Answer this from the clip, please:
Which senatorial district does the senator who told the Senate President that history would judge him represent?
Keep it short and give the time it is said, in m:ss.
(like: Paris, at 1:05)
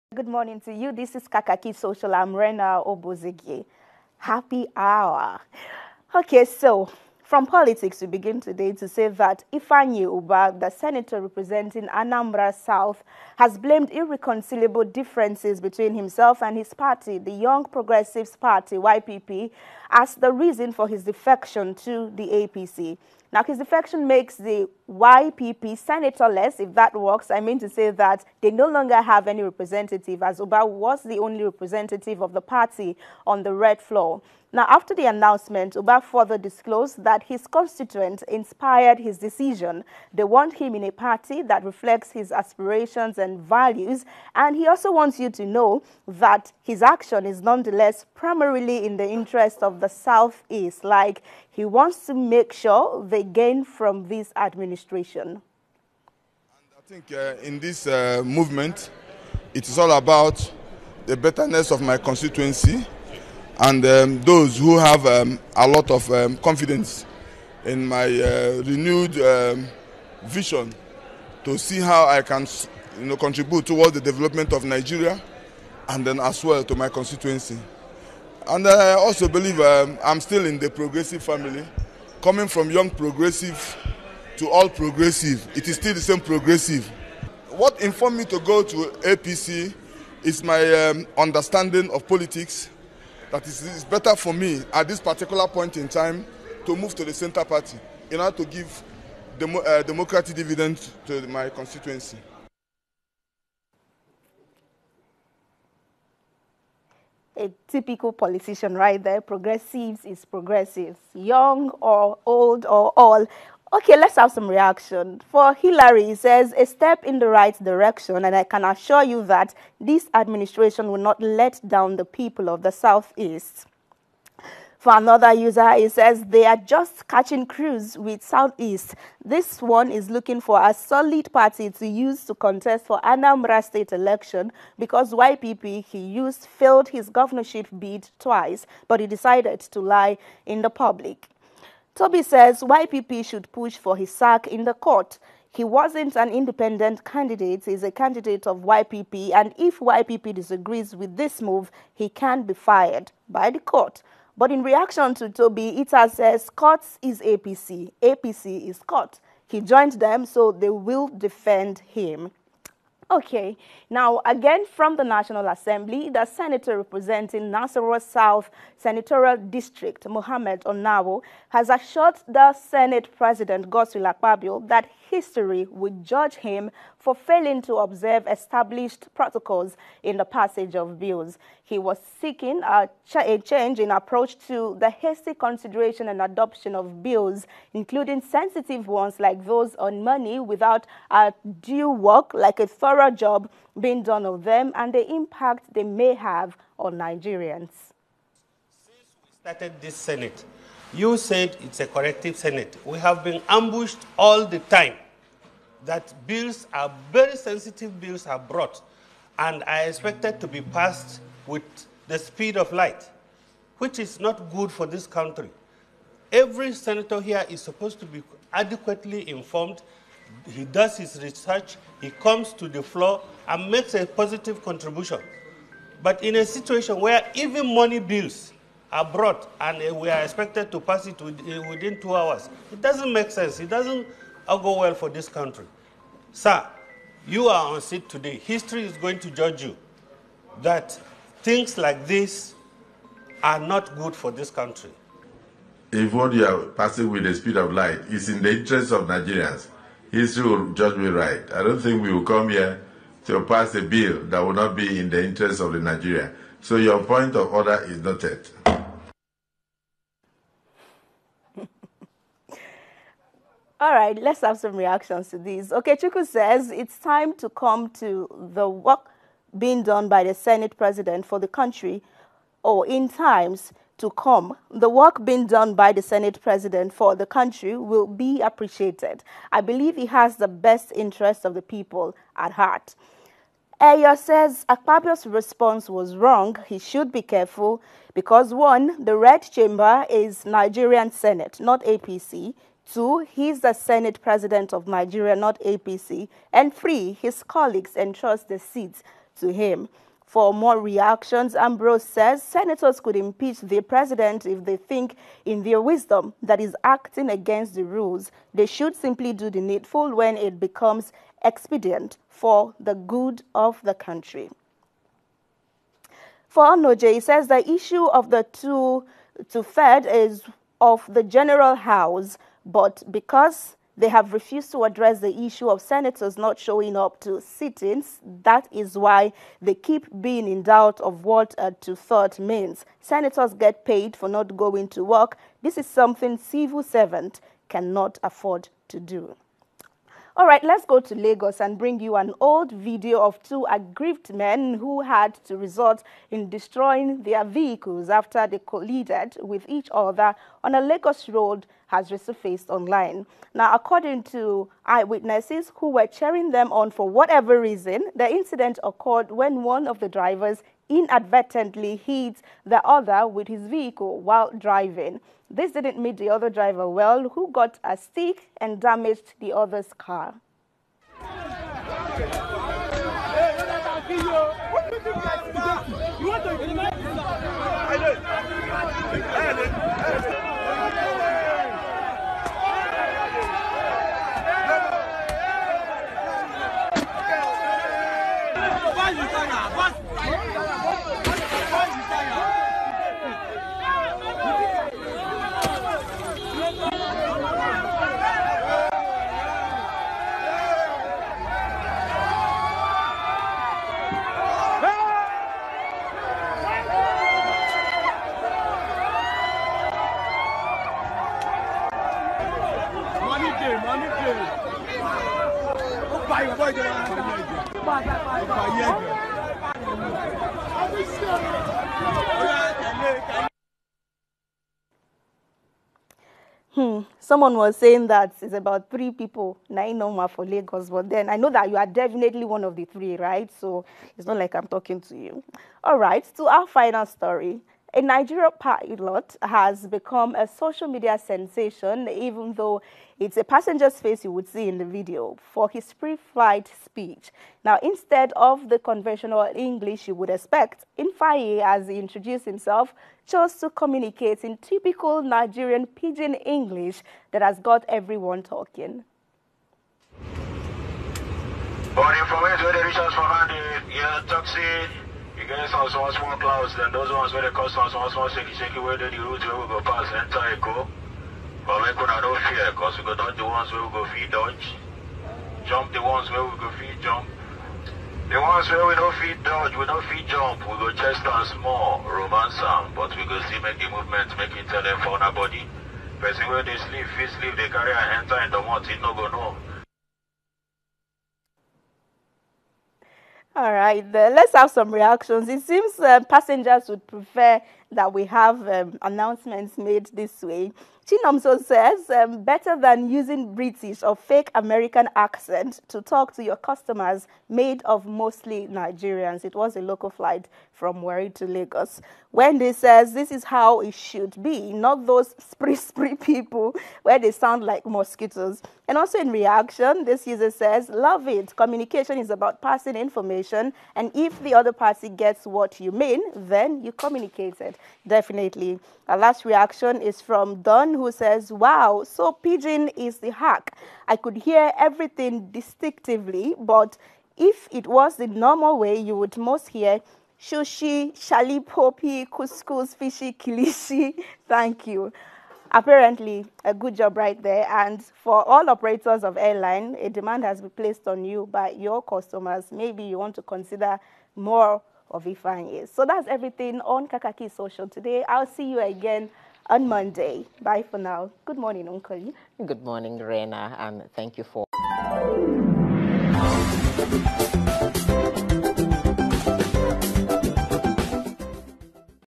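Nasarawa South, at 2:47.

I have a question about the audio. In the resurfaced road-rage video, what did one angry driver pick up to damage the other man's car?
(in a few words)
a stick.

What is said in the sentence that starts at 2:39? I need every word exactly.
He joined them, so they will defend him.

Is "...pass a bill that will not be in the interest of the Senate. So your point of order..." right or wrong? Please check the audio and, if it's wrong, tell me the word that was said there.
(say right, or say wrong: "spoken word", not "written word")
wrong: "Nigeria", not "Senate".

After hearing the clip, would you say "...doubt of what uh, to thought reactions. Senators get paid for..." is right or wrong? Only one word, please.
wrong.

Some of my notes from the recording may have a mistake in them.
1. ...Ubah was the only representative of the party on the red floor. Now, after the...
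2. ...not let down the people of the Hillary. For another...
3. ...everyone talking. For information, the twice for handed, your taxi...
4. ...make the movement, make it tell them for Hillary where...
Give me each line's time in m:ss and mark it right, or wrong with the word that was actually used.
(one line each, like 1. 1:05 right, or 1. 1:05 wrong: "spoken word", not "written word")
1. 0:30 right
2. 2:00 wrong: "Southeast", not "Hillary"
3. 7:37 wrong: "resource", not "twice"
4. 8:03 wrong: "Person", not "Hillary".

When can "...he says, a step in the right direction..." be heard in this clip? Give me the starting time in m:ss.
1:56.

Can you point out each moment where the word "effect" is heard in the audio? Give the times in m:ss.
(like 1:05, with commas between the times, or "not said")
not said.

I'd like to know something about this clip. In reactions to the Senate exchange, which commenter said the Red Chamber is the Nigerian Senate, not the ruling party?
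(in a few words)
Eyo.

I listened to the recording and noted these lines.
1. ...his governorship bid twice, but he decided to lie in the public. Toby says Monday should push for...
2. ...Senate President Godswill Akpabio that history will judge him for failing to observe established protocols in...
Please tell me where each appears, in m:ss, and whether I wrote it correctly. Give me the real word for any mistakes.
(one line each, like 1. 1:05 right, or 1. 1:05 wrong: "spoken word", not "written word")
1. 2:16 wrong: "YPP", not "Monday"
2. 2:52 right.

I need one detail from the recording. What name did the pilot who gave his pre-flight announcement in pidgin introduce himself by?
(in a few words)
Infaye.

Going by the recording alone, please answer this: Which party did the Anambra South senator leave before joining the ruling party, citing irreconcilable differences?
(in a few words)
Young Progressives Party.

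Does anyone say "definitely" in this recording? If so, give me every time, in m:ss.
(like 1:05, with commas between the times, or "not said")
7:11, 8:48.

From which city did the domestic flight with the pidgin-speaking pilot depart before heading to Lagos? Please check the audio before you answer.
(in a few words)
Warri.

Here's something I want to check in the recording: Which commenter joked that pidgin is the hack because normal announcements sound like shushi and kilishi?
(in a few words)
Don.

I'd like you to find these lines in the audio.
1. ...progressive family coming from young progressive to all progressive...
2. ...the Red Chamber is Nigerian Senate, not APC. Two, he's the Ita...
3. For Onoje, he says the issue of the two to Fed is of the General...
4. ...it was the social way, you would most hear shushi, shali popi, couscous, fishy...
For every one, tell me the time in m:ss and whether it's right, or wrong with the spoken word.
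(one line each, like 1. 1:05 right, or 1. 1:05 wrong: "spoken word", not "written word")
1. 1:20 right
2. 4:49 wrong: "Senate", not "Ita"
3. 5:16 right
4. 8:57 wrong: "normal", not "social".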